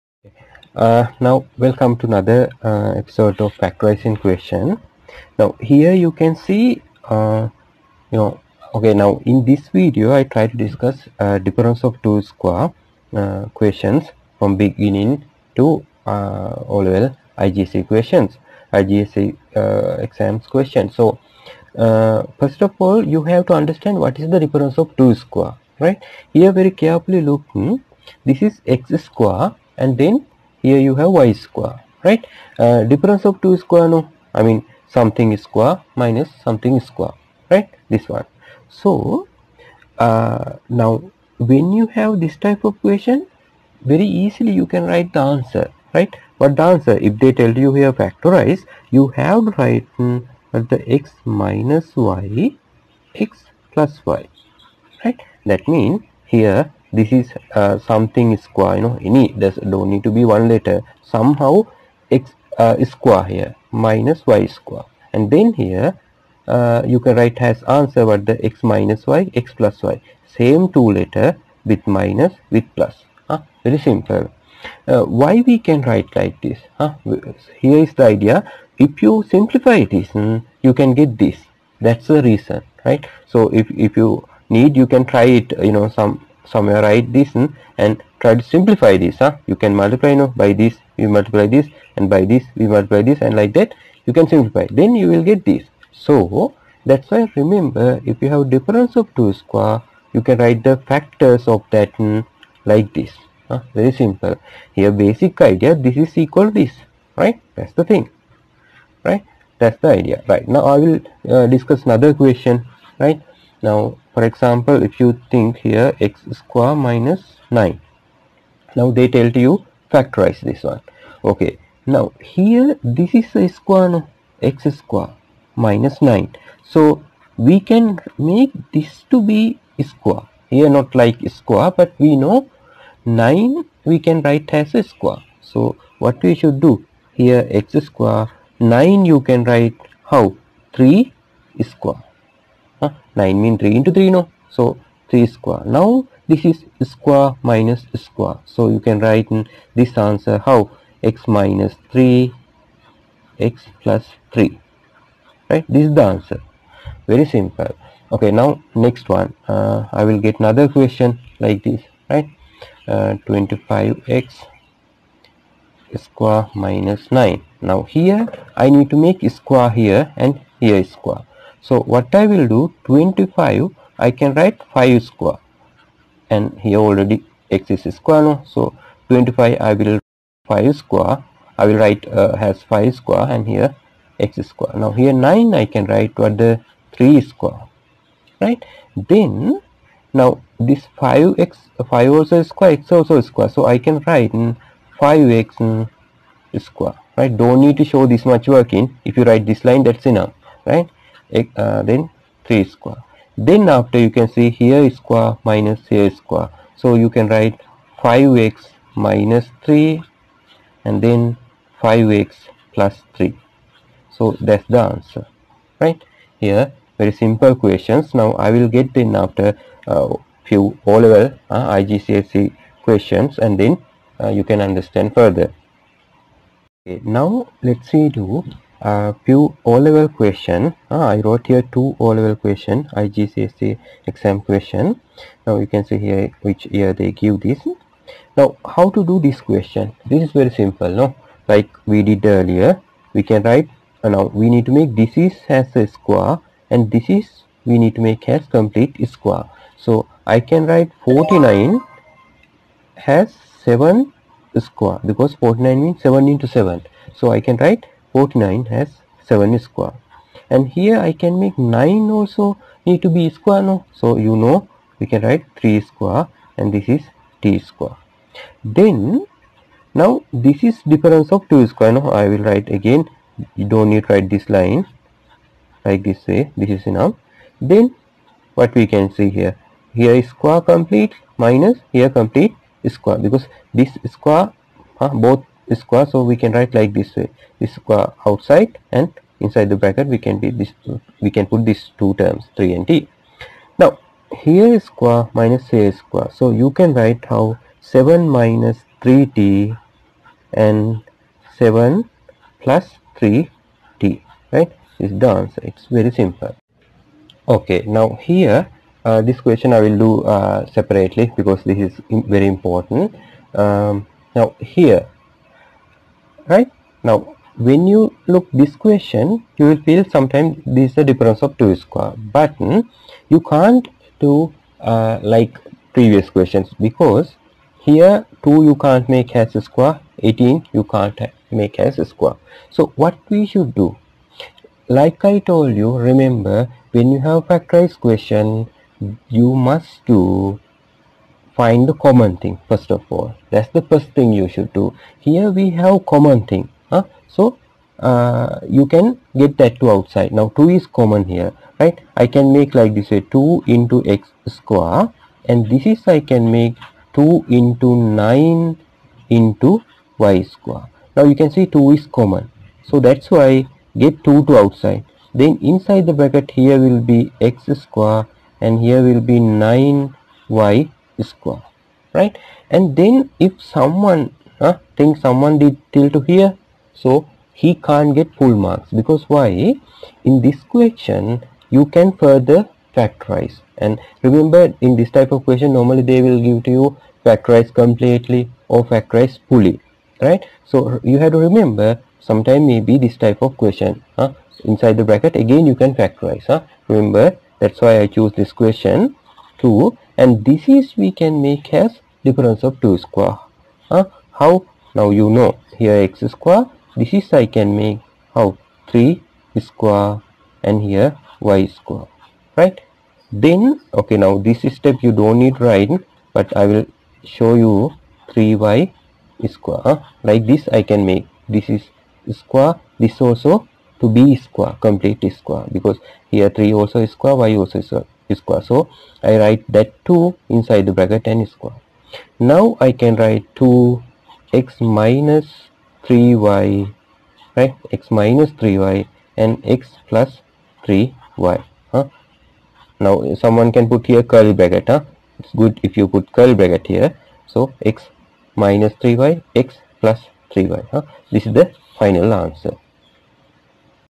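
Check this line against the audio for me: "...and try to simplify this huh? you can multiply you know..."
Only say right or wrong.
right.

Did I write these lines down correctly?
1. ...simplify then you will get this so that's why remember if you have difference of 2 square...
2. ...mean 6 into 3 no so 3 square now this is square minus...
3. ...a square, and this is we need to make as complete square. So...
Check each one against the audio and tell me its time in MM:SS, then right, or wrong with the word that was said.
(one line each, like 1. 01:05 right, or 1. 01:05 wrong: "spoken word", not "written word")
1. 01:34 right
2. 02:23 wrong: "3", not "6"
3. 04:05 right.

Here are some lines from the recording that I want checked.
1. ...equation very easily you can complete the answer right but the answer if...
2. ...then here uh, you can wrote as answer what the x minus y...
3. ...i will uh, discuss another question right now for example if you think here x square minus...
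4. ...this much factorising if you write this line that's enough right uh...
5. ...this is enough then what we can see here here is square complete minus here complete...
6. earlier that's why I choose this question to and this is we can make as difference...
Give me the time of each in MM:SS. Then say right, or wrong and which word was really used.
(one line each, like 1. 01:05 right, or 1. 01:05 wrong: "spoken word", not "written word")
1. 00:42 wrong: "write", not "complete"
2. 01:05 wrong: "write", not "wrote"
3. 01:50 right
4. 03:18 wrong: "working", not "factorising"
5. 04:36 right
6. 06:36 wrong: "remember", not "earlier".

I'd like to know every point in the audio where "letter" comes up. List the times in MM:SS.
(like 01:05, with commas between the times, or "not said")
01:00, 01:10.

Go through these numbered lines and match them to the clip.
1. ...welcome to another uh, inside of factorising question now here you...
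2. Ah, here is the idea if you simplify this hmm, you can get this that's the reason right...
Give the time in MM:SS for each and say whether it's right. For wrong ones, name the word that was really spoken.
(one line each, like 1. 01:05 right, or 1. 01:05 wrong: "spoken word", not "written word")
1. 00:01 wrong: "episode", not "inside"
2. 01:17 right.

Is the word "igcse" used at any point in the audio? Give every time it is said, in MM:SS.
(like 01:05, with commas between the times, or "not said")
03:41, 03:52.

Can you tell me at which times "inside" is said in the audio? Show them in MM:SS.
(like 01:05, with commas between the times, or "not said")
04:49, 06:05, 06:34, 07:10.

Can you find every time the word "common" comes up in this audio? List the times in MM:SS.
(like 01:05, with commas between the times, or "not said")
05:41, 05:46, 05:50, 06:02.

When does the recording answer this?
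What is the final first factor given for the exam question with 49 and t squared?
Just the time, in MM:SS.
04:57.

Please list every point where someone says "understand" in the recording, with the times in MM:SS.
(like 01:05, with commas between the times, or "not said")
00:23, 03:44.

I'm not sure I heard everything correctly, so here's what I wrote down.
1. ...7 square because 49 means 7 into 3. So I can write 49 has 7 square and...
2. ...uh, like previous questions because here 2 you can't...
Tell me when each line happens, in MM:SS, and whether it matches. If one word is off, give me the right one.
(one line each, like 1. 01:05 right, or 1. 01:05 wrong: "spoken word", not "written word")
1. 04:13 wrong: "7", not "3"
2. 05:24 right.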